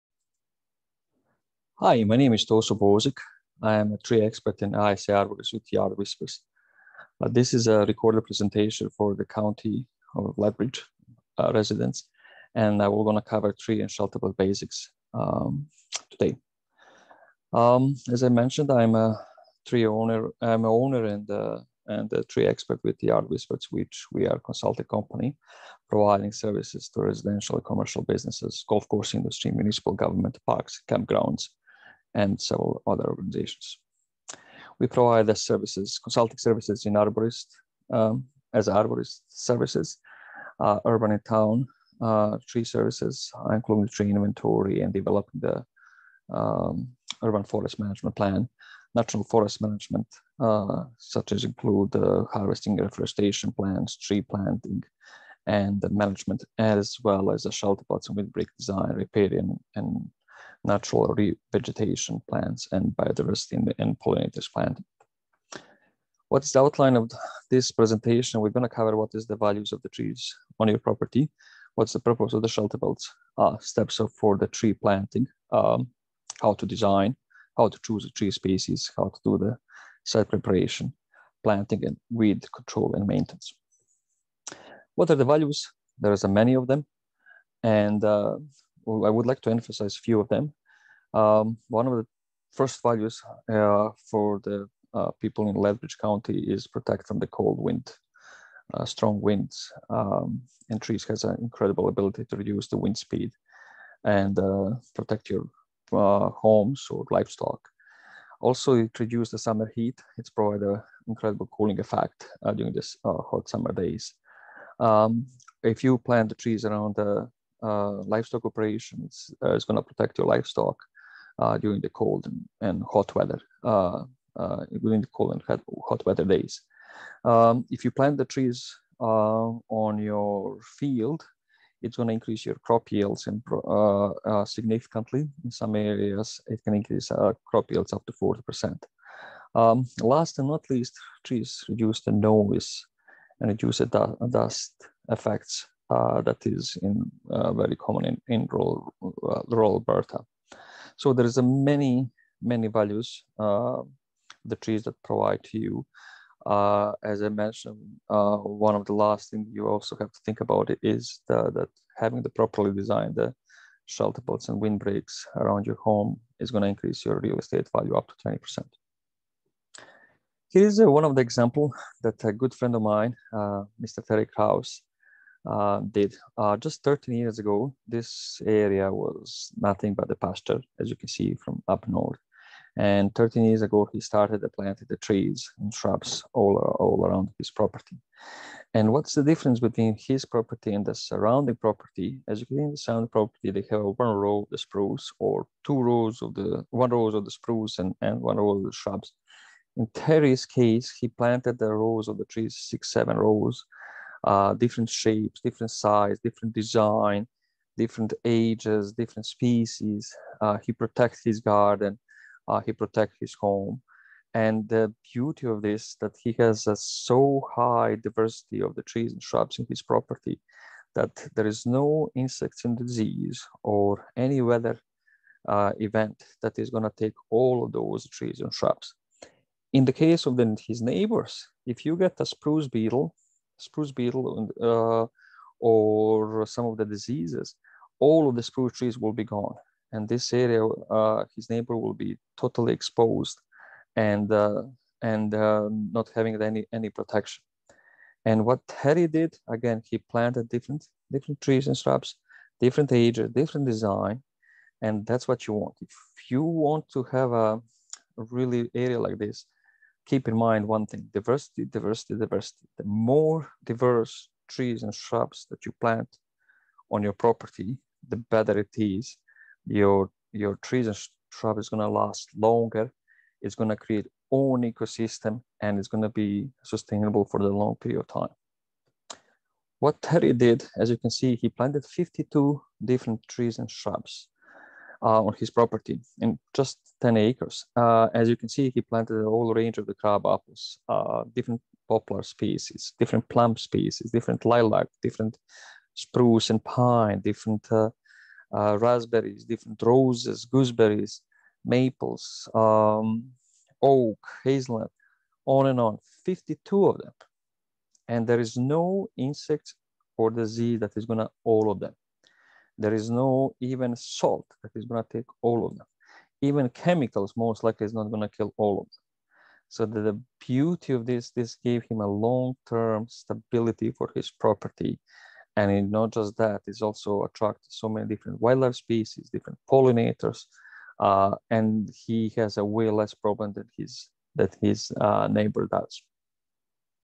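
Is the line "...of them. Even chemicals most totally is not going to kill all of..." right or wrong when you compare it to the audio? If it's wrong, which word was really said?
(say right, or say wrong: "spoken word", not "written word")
wrong: "likely", not "totally".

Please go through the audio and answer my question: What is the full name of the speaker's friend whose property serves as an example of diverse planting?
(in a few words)
Terry Kraus.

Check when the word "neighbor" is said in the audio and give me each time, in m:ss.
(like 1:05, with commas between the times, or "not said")
3:50, 4:01, 5:35.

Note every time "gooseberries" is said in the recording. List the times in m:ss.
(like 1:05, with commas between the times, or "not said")
5:00.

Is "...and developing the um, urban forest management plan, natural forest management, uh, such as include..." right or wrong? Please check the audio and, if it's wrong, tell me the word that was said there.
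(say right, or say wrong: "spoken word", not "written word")
right.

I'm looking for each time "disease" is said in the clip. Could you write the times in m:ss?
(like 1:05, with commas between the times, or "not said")
3:42, 3:56, 5:10.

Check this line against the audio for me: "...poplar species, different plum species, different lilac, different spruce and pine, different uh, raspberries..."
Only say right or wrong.
right.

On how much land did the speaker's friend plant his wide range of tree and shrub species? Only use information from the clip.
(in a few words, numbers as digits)
10 acres.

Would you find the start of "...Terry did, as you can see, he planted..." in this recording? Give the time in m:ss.
4:40.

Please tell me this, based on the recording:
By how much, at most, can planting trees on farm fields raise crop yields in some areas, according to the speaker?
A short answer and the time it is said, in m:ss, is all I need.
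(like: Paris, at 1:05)
40%, at 2:18.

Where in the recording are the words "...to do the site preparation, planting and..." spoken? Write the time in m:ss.
1:19.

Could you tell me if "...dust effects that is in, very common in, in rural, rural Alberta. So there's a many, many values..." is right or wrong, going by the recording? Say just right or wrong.
right.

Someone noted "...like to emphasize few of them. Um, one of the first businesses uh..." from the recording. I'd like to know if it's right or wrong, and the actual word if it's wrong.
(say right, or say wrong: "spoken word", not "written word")
wrong: "values", not "businesses".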